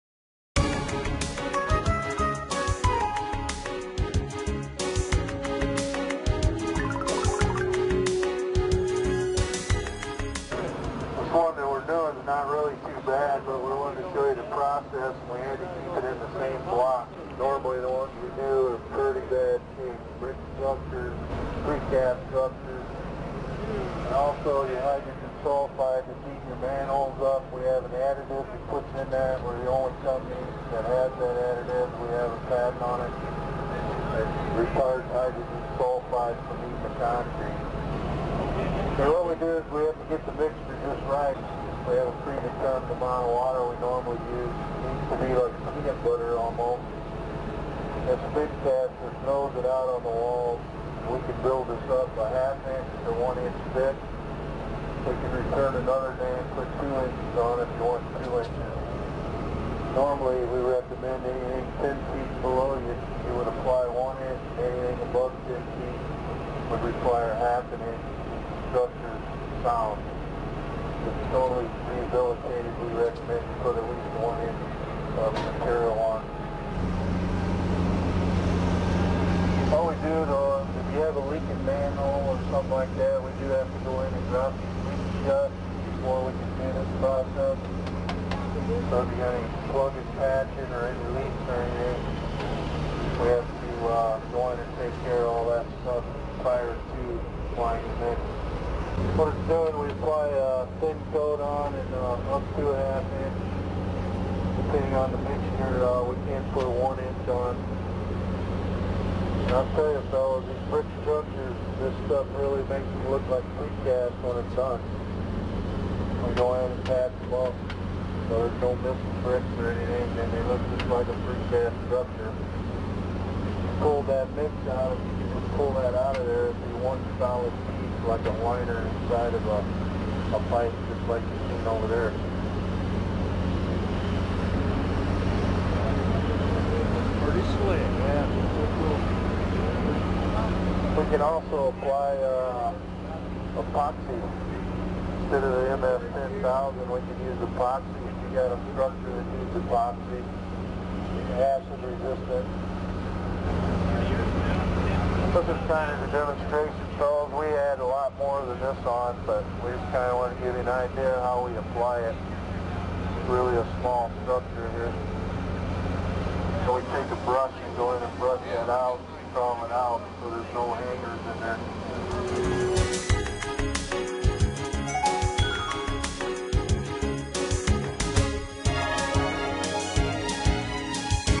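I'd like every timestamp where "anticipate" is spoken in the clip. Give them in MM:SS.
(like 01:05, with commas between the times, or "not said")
not said.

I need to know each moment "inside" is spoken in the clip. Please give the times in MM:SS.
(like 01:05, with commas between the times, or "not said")
02:08.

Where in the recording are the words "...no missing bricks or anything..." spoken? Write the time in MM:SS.
01:58.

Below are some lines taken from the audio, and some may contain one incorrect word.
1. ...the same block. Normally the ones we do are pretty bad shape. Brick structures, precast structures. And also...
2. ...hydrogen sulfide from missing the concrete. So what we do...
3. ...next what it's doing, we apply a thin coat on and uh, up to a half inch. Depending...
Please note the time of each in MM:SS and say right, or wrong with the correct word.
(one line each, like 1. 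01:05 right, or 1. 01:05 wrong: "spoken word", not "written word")
1. 00:16 right
2. 00:35 wrong: "eating", not "missing"
3. 01:38 right.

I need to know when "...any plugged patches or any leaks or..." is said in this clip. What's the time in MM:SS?
01:29.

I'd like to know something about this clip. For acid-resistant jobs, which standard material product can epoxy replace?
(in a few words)
MF-10000.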